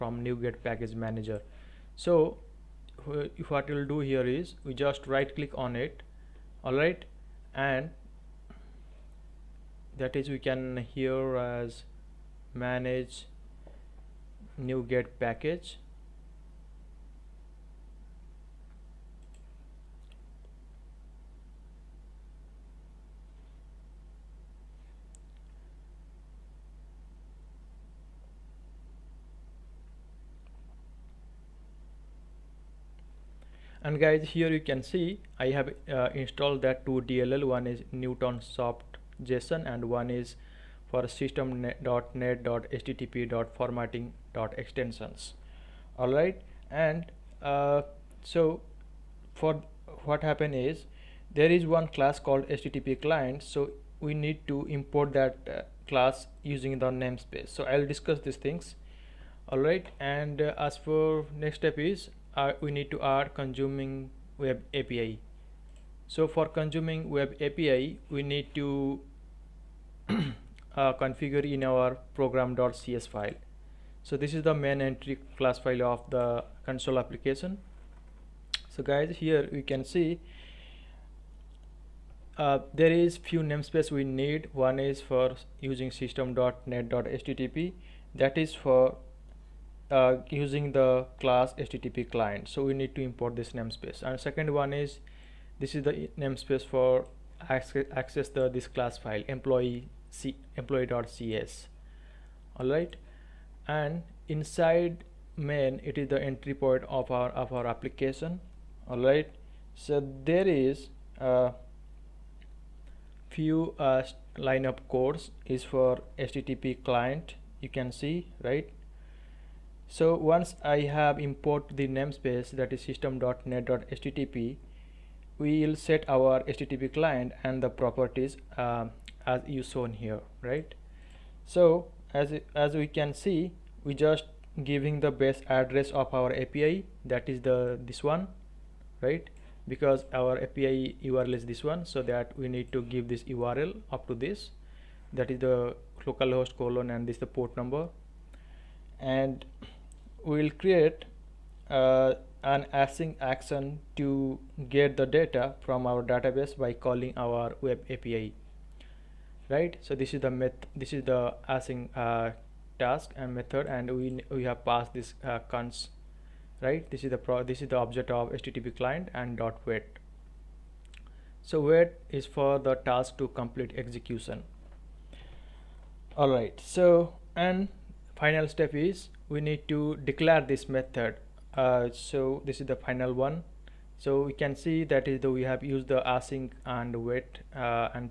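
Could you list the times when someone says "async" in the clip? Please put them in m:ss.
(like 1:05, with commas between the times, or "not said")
2:32, 2:41, 3:06.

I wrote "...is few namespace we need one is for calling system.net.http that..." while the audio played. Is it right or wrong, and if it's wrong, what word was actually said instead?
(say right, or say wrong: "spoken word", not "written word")
wrong: "using", not "calling".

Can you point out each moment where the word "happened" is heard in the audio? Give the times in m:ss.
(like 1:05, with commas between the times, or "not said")
0:50.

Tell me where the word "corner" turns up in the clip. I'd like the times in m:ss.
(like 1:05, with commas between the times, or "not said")
not said.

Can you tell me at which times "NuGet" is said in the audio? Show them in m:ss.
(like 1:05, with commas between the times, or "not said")
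0:00, 0:14.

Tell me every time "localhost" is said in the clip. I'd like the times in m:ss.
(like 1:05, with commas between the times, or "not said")
2:26.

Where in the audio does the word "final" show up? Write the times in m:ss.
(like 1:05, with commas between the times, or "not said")
2:58, 3:02.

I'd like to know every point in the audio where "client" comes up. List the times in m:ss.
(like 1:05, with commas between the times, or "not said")
0:53, 1:32, 1:56, 2:06, 2:48.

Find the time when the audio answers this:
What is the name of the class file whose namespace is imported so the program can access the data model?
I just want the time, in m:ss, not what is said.
1:40.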